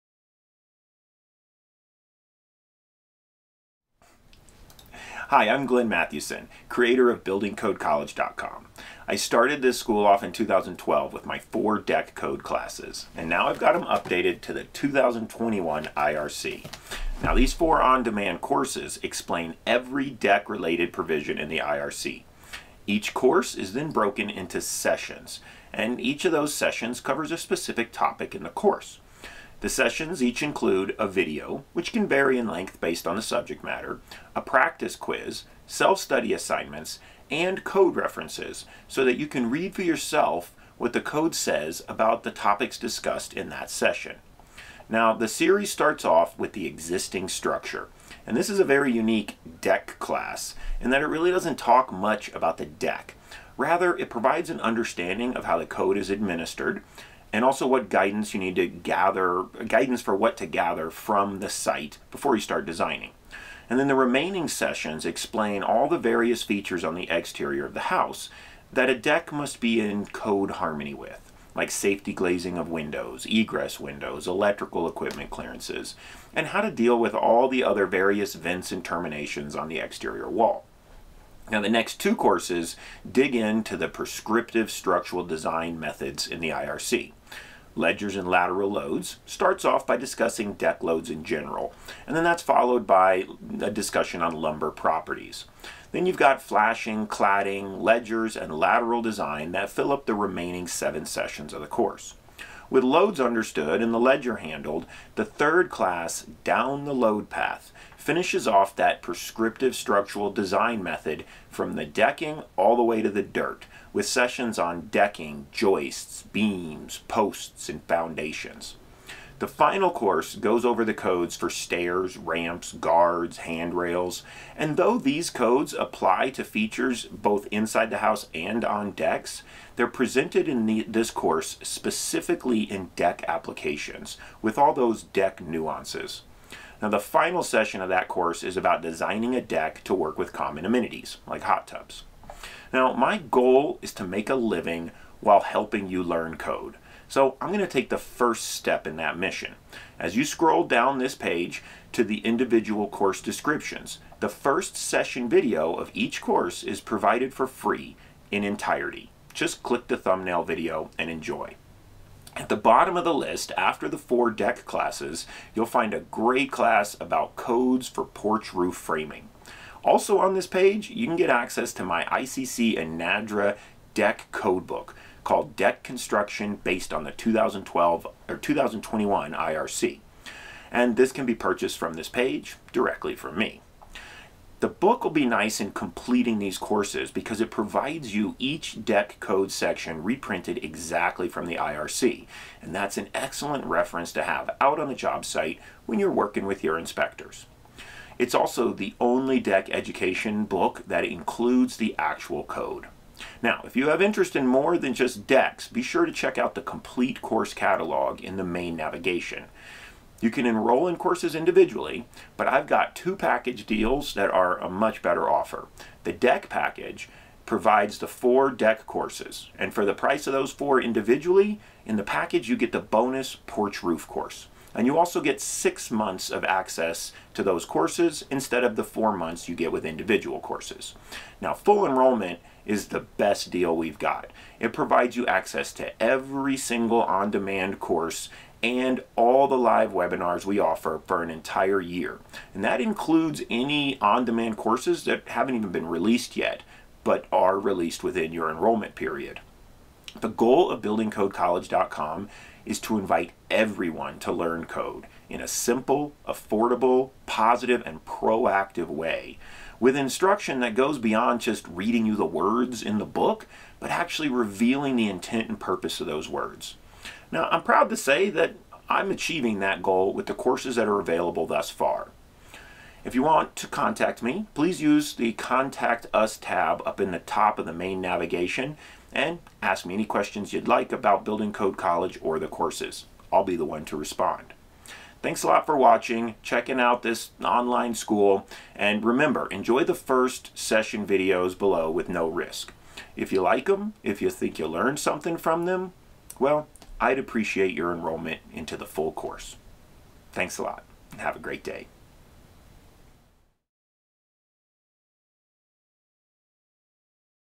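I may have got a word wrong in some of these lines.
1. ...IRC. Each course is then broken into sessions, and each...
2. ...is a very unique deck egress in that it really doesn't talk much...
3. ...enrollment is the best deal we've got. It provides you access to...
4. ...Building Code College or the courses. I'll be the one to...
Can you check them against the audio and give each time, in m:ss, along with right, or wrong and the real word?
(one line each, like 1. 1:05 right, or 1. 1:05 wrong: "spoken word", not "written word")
1. 0:21 right
2. 0:48 wrong: "class", not "egress"
3. 3:51 right
4. 4:41 right.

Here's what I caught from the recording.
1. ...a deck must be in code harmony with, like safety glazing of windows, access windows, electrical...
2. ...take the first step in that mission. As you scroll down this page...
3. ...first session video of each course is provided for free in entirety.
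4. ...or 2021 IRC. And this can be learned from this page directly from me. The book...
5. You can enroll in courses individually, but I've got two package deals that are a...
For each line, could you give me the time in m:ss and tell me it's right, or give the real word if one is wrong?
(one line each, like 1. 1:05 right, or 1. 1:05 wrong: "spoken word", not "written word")
1. 1:08 wrong: "egress", not "access"
2. 2:27 right
3. 2:34 right
4. 2:58 wrong: "purchased", not "learned"
5. 3:30 right.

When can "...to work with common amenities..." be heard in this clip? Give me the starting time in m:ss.
2:19.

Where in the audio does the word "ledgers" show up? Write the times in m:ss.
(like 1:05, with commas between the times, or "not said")
1:27, 1:37, 1:43.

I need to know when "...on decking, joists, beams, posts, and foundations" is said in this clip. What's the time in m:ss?
1:54.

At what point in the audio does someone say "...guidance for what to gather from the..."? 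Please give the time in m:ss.
0:59.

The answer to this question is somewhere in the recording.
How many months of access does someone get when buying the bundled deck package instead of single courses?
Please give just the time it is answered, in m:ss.
3:45.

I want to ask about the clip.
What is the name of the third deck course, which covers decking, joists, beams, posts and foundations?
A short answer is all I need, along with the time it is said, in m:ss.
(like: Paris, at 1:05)
Down the load path, at 1:46.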